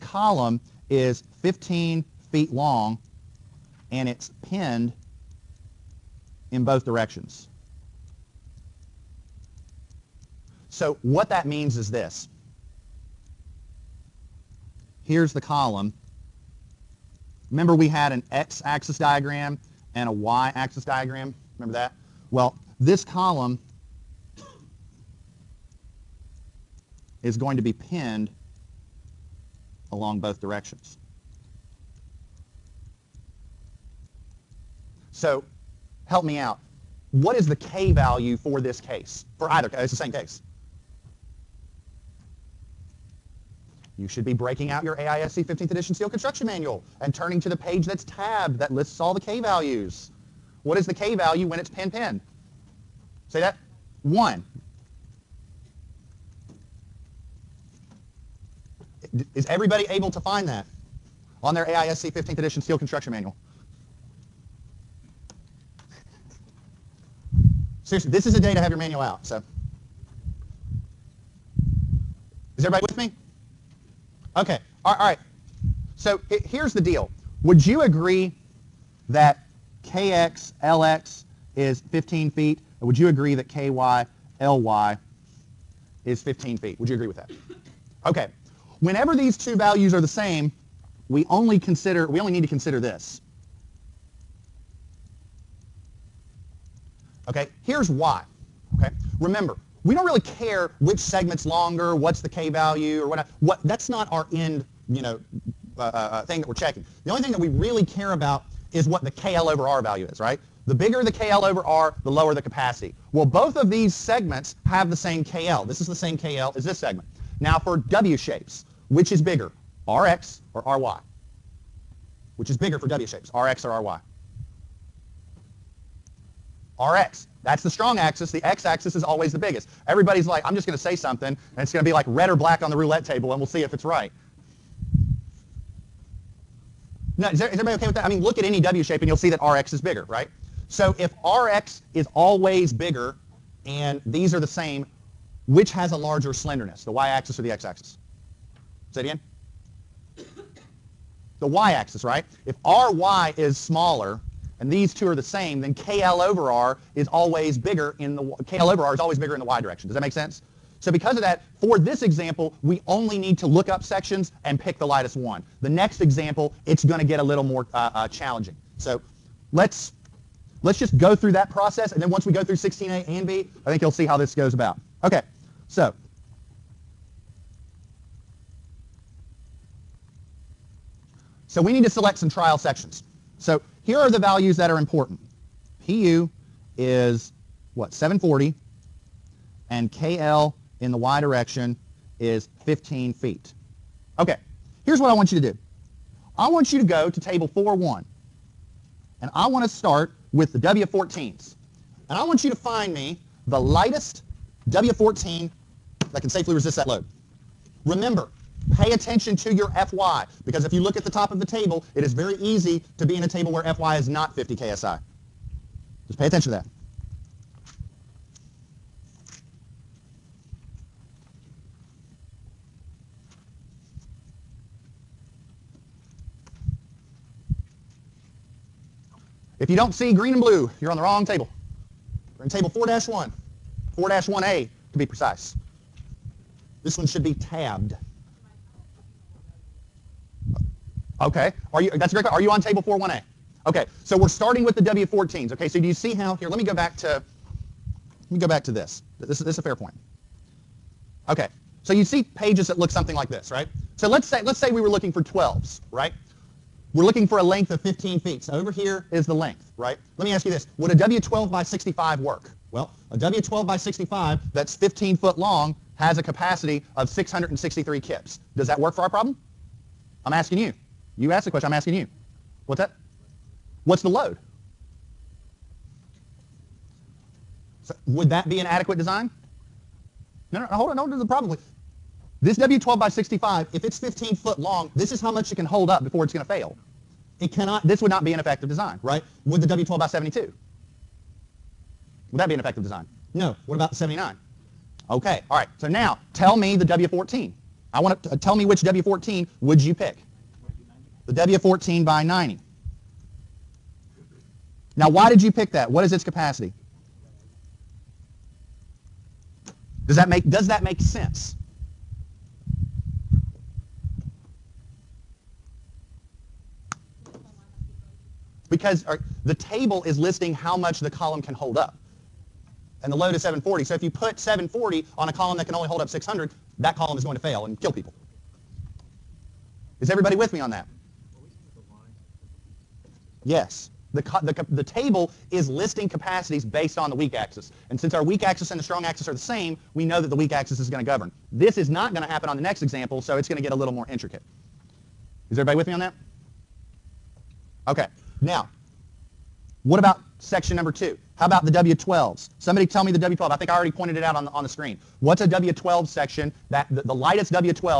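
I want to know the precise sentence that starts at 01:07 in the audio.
Seriously, this is a day to have your manual out, so.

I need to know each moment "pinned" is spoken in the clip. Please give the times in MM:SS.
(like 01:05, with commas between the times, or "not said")
00:04, 00:27, 00:51.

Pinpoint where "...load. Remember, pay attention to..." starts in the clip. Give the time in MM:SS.
03:26.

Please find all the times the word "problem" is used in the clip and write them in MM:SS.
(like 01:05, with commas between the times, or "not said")
04:29, 04:41.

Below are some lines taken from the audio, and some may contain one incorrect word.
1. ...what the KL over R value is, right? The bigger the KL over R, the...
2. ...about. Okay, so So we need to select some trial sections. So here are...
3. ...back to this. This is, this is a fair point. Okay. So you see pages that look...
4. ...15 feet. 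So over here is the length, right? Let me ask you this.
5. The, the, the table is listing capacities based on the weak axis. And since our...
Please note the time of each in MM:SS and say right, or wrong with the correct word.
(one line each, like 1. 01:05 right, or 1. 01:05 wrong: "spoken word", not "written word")
1. 01:48 right
2. 02:54 right
3. 04:08 right
4. 04:17 right
5. 05:34 right.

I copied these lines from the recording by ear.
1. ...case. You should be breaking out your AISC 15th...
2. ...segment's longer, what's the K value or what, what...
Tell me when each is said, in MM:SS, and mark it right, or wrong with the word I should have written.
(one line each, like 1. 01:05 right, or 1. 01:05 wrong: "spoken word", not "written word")
1. 00:40 right
2. 01:40 right.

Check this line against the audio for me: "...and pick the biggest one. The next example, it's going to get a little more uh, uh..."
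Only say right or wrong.
wrong.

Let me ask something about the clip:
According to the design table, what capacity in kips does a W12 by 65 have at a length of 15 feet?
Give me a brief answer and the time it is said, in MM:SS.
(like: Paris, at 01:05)
663 kips, at 04:27.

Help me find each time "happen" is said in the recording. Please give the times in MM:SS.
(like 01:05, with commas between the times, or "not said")
05:42.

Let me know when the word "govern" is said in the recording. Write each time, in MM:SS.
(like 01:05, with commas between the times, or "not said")
05:41.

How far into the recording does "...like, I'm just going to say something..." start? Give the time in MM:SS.
02:10.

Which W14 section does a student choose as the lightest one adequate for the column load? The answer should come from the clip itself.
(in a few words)
W14 by 90.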